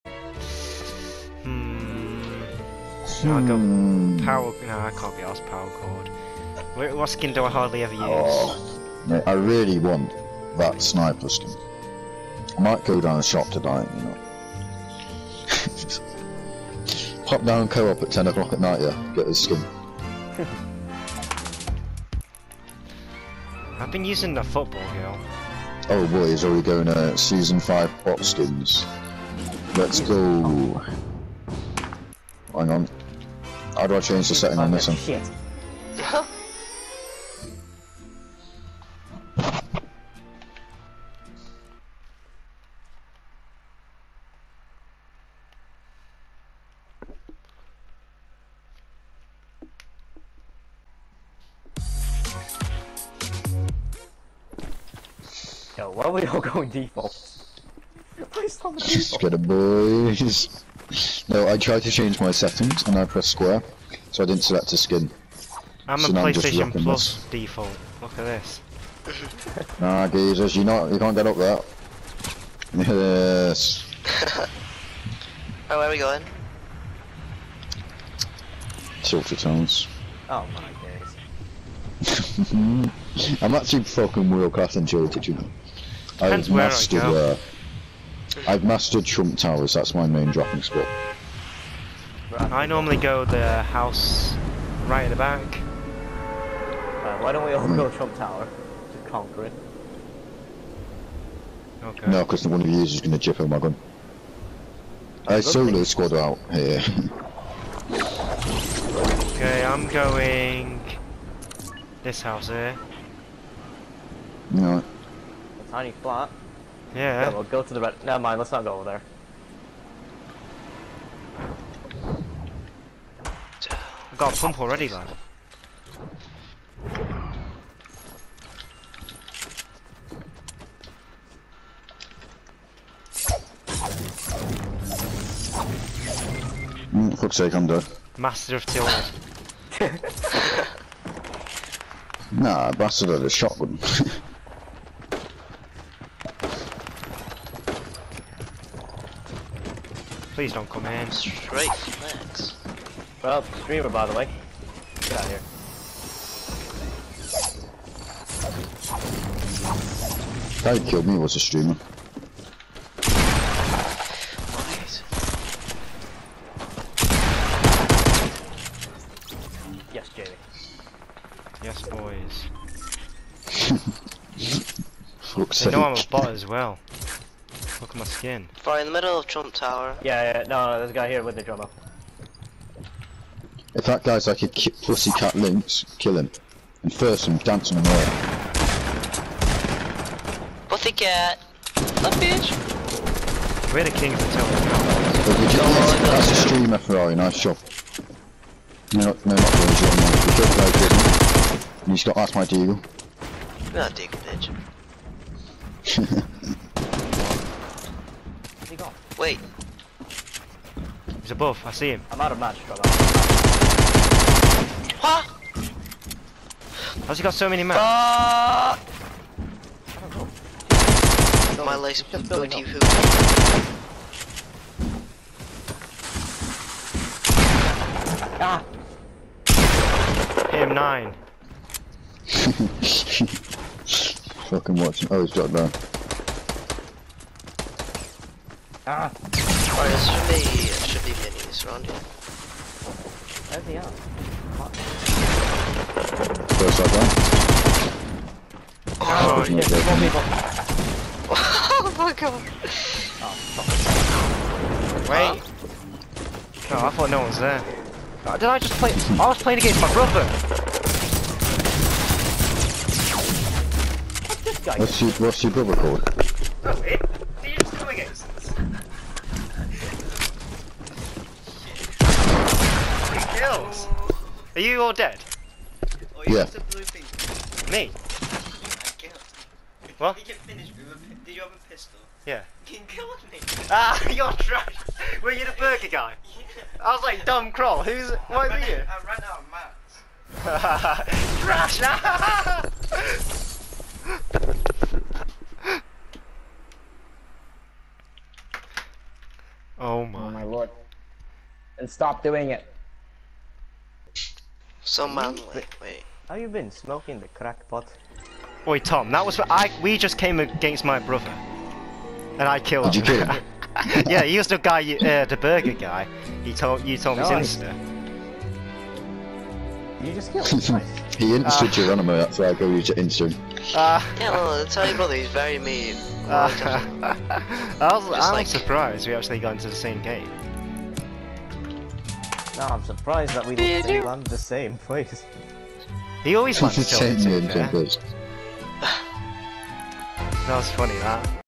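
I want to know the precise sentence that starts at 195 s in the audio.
That's a streamer Ferrari, nice job.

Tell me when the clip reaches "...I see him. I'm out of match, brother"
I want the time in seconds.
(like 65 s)
211 s.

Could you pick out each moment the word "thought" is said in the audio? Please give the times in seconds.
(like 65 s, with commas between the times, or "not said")
256 s.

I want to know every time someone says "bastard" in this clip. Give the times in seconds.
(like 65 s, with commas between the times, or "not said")
142 s.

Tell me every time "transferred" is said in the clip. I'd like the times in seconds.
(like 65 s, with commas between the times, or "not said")
not said.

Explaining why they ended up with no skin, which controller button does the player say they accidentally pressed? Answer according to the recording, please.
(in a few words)
Square.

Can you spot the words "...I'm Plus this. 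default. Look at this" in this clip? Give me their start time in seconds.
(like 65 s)
66 s.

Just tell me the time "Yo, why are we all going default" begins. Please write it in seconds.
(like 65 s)
55 s.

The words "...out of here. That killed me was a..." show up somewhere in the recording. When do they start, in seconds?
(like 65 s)
155 s.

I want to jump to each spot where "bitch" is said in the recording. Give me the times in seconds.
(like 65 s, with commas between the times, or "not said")
192 s, 204 s.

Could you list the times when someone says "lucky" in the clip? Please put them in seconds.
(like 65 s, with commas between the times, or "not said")
not said.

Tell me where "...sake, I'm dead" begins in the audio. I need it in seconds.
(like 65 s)
137 s.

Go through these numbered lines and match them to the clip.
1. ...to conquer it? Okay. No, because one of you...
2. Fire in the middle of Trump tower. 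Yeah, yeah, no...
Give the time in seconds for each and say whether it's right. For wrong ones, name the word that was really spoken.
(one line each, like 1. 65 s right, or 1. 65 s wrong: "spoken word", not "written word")
1. 98 s right
2. 178 s right.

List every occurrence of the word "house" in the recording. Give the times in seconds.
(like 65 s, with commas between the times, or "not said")
93 s, 112 s.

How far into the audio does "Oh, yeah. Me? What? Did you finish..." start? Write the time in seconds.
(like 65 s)
276 s.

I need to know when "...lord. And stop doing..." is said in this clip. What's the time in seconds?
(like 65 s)
300 s.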